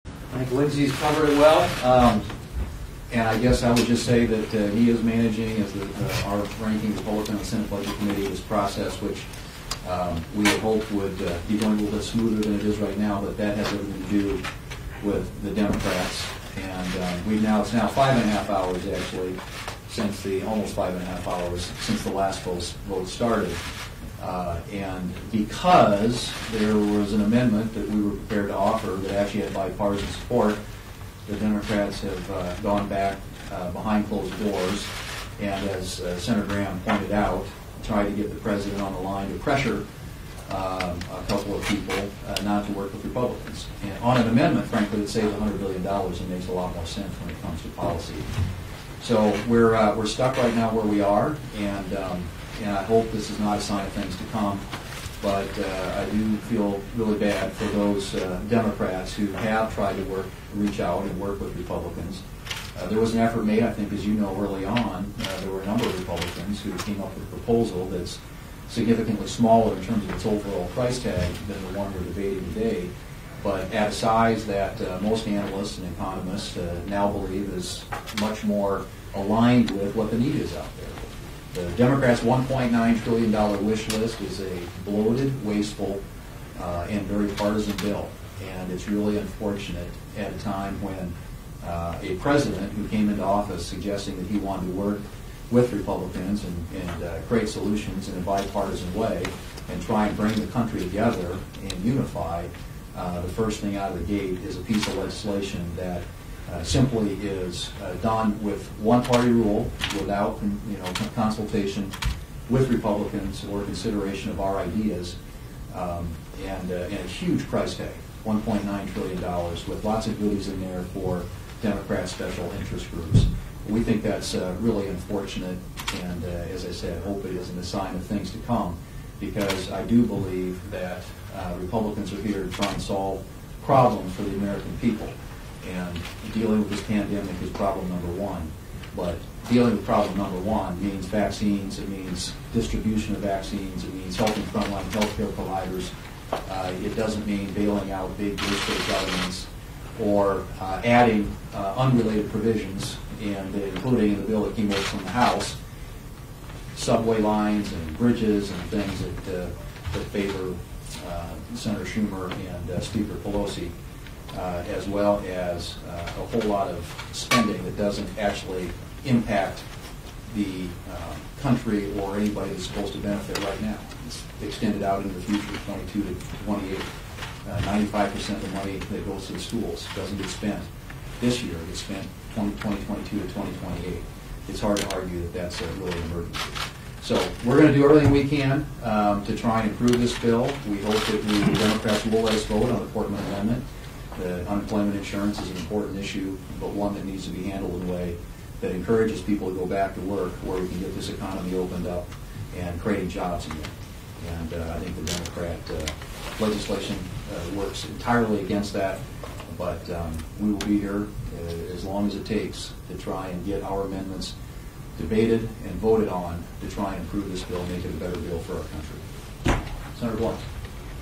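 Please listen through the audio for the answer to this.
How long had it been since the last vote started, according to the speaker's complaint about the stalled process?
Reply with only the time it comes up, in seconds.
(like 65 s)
20 s.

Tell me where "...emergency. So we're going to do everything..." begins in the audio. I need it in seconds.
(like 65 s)
186 s.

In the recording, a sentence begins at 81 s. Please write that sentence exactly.
The Democrats' $1.9 trillion wish list is a bloated, wasteful, uh, and very partisan bill.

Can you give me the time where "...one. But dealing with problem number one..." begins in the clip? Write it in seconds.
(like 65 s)
138 s.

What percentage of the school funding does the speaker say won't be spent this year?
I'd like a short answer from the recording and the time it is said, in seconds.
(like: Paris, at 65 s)
95%, at 177 s.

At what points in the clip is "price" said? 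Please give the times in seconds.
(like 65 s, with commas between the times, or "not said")
70 s, 117 s.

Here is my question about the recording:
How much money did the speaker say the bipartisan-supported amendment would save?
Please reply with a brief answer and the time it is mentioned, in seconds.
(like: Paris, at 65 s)
$100 billion, at 45 s.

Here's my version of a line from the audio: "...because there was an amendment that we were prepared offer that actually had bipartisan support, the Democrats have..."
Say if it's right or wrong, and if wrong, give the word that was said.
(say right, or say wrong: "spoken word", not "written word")
right.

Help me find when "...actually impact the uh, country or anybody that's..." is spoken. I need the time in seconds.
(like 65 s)
168 s.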